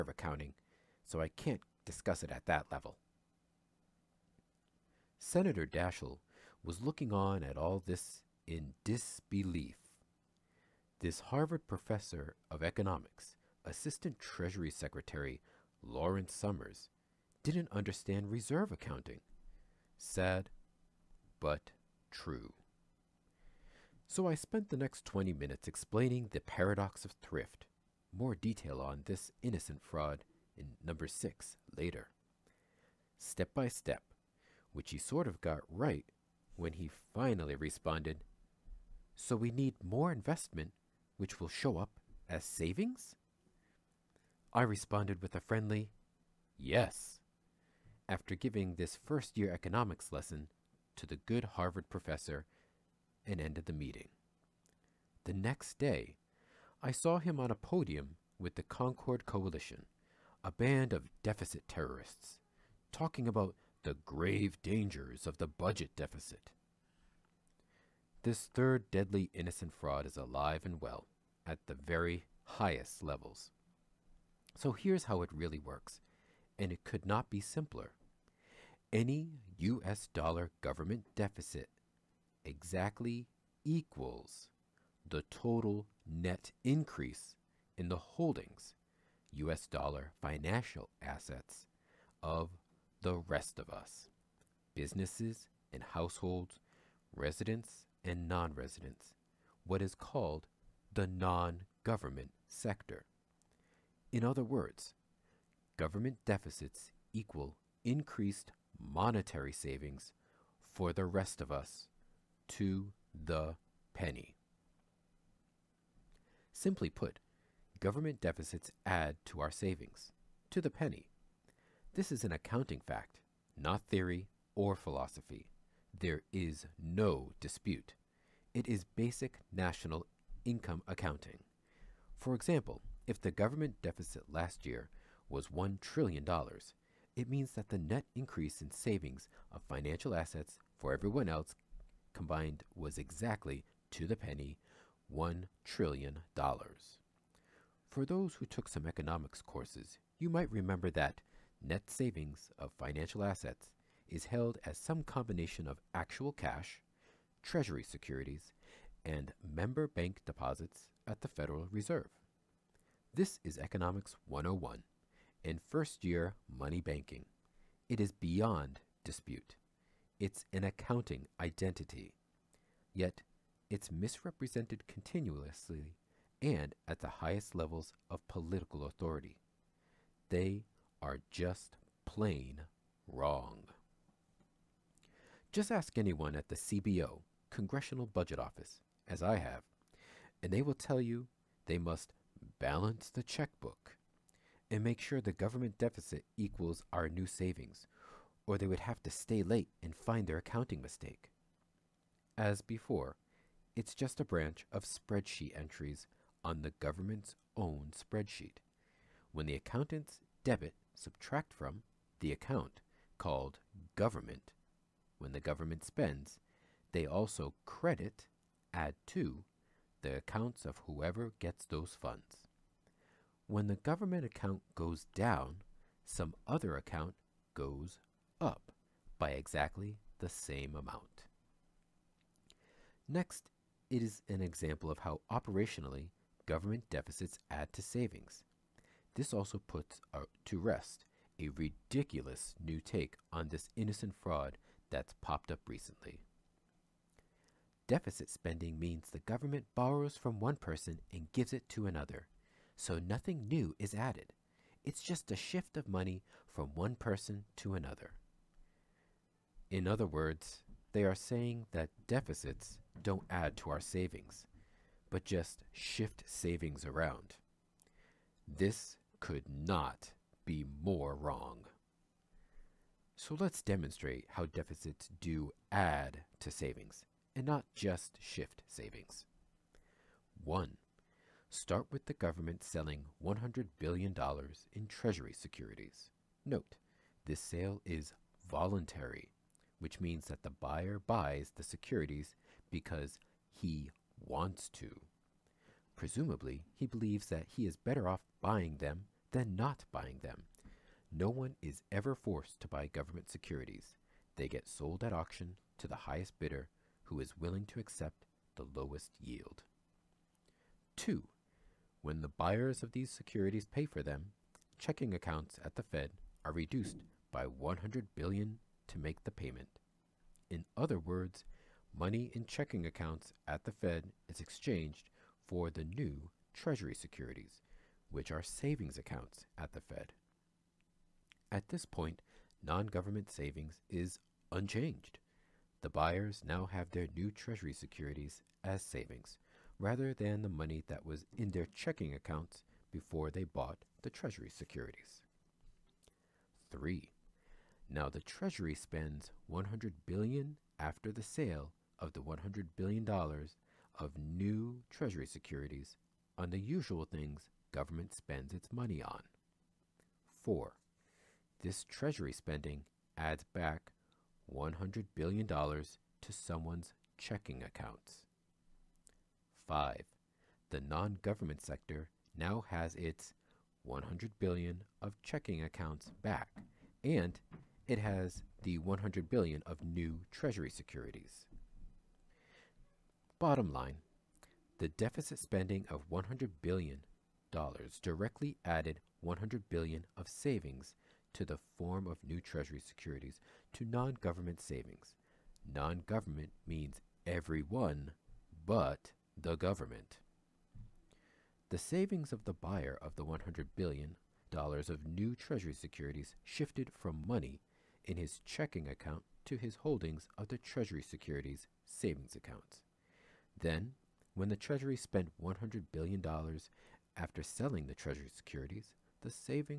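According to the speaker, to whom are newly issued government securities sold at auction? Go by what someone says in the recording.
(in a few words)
the highest bidder.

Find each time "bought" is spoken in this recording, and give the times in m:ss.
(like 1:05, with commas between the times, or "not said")
5:43.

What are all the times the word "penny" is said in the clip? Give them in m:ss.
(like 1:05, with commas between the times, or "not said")
1:53, 2:00, 2:24.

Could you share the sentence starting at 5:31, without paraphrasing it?
At this point, non government savings is unchanged.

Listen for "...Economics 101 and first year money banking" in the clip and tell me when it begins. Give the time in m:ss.
2:43.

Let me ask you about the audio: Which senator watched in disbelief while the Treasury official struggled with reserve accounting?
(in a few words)
Senator Daschle.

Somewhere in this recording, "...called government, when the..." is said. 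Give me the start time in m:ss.
3:33.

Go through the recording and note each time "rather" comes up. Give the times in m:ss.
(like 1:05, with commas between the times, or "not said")
5:39.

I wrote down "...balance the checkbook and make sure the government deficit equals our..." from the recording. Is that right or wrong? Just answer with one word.
right.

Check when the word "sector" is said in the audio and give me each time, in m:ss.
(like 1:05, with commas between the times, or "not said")
1:42, 6:11.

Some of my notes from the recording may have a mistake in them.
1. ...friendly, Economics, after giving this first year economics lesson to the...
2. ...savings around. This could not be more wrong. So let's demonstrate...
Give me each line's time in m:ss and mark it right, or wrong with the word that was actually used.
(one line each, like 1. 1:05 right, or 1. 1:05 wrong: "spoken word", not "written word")
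1. 0:45 wrong: "Yes", not "Economics"
2. 4:26 right.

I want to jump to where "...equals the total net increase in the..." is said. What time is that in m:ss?
1:23.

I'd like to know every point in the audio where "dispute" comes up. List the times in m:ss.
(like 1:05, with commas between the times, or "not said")
2:07, 2:49.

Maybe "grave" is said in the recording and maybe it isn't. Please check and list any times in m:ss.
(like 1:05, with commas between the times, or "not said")
1:04.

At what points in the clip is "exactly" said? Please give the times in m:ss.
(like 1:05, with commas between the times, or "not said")
1:22, 2:22, 3:49.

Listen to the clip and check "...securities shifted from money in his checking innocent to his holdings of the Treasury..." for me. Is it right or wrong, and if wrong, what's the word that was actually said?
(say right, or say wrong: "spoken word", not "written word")
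wrong: "account", not "innocent".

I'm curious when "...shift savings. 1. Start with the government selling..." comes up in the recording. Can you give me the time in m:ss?
4:38.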